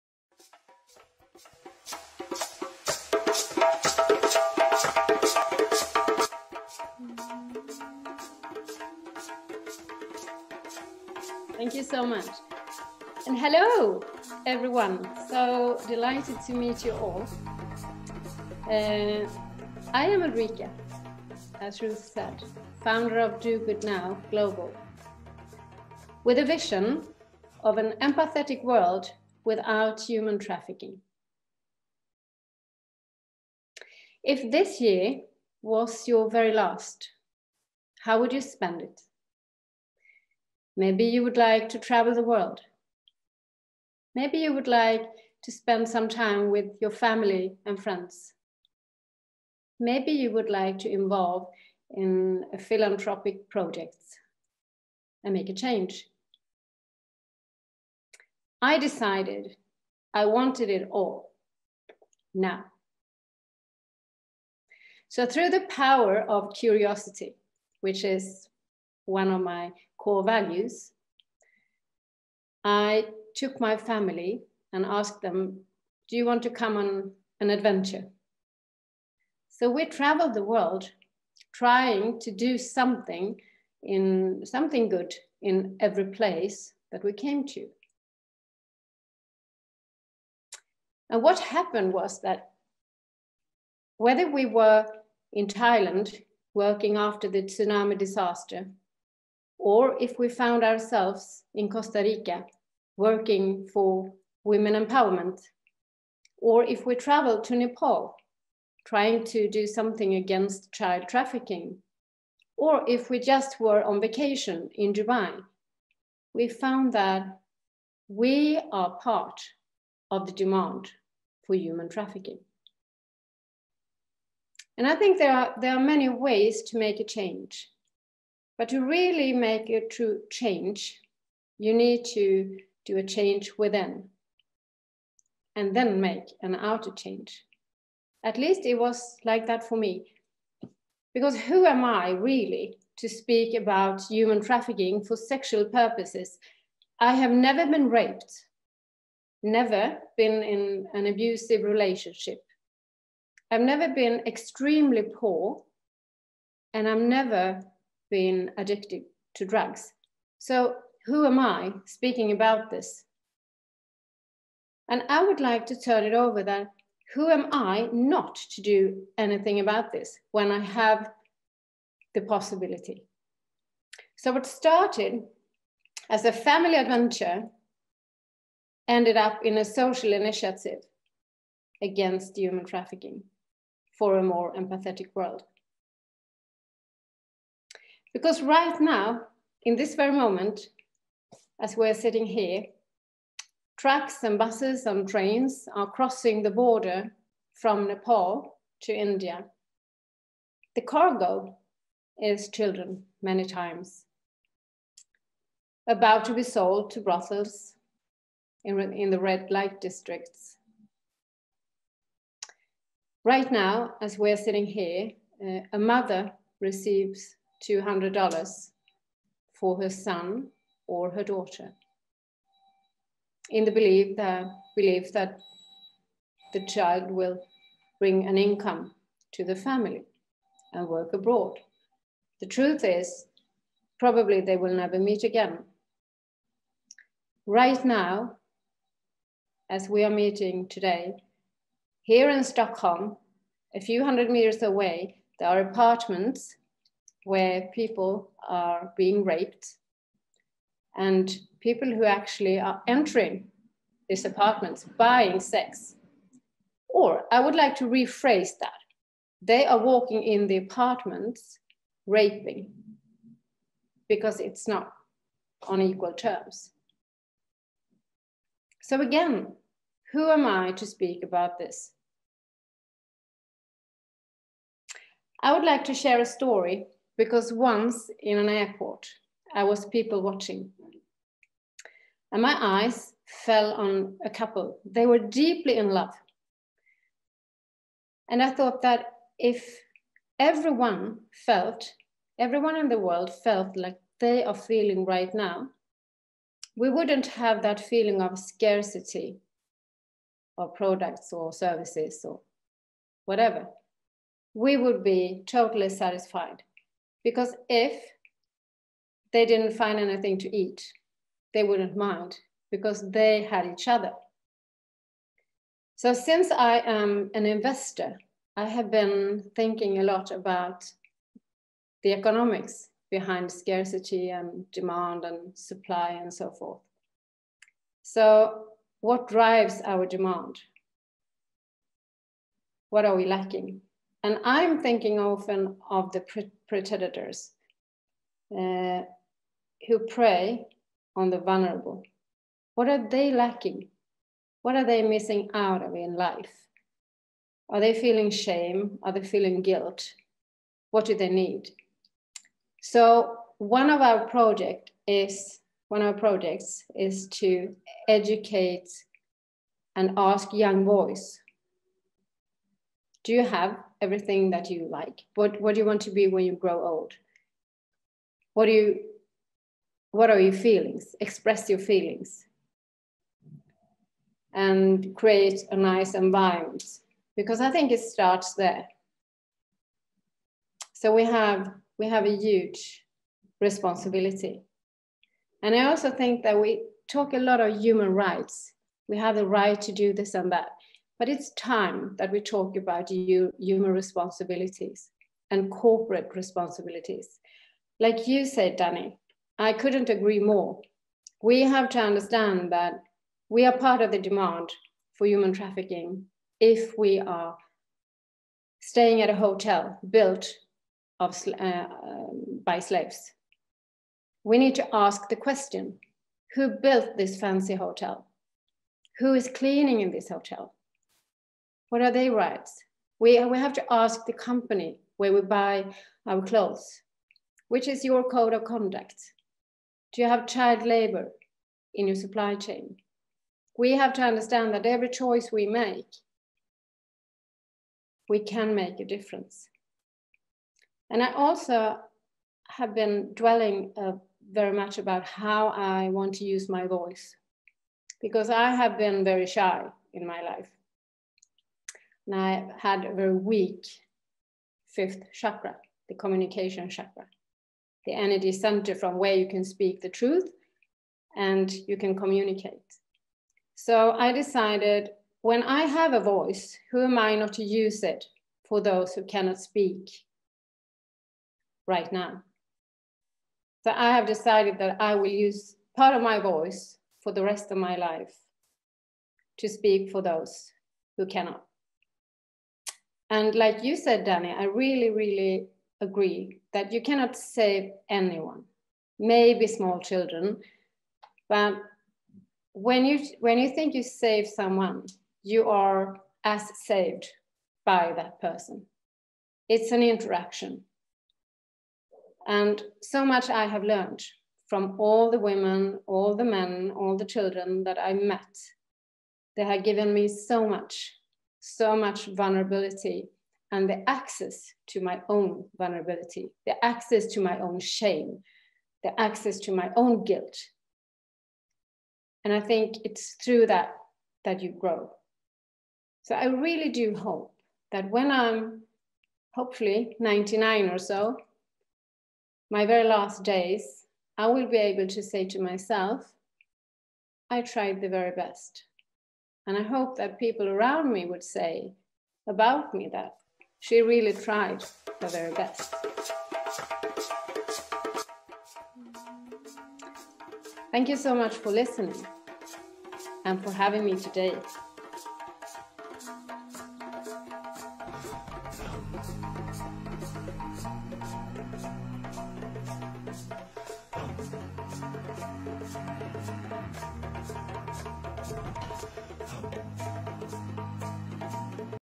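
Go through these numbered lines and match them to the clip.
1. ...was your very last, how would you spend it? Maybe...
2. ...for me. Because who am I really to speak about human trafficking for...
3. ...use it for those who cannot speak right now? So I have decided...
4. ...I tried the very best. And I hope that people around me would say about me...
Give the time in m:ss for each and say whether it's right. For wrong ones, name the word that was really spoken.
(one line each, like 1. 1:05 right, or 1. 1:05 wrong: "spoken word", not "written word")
1. 0:35 right
2. 2:19 right
3. 7:47 right
4. 8:57 right.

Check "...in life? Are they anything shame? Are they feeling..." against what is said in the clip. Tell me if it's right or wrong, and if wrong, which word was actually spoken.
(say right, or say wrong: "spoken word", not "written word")
wrong: "feeling", not "anything".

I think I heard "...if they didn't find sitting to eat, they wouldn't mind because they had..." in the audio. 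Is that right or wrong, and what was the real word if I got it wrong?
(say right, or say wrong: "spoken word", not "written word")
wrong: "anything", not "sitting".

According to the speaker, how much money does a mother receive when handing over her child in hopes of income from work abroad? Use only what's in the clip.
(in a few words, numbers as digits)
$200.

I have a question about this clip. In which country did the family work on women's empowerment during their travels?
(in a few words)
Costa Rica.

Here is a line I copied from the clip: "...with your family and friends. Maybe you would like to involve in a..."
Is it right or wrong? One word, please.
right.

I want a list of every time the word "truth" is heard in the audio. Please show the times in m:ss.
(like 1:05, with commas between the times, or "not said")
3:52, 7:40.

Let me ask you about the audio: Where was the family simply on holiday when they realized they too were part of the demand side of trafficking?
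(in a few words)
Dubai.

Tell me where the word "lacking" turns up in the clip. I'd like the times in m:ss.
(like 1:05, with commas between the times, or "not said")
5:33, 5:43.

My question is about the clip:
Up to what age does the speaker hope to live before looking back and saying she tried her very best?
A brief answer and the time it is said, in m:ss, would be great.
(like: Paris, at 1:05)
99, at 8:50.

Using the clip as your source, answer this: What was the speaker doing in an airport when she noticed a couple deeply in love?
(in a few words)
people watching.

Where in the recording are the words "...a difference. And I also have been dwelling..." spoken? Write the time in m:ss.
7:19.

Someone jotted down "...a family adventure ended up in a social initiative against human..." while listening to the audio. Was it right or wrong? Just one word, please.
right.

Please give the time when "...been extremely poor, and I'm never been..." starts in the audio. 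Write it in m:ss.
2:33.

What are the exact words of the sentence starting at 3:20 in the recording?
The cargo is children many times, about to be sold to brothels in, in the red light districts.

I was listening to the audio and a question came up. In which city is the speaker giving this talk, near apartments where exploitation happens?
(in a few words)
Stockholm.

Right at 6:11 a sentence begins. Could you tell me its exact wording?
Express your feelings and create a nice environment because I think it starts there.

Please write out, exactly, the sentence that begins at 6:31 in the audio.
But it's time that we talk about human responsibilities and corporate responsibilities.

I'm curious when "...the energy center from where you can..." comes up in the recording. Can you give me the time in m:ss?
7:38.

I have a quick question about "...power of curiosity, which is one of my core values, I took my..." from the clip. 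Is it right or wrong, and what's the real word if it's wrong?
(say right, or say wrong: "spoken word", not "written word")
right.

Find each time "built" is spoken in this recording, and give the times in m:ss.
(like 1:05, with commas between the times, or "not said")
6:50, 6:56.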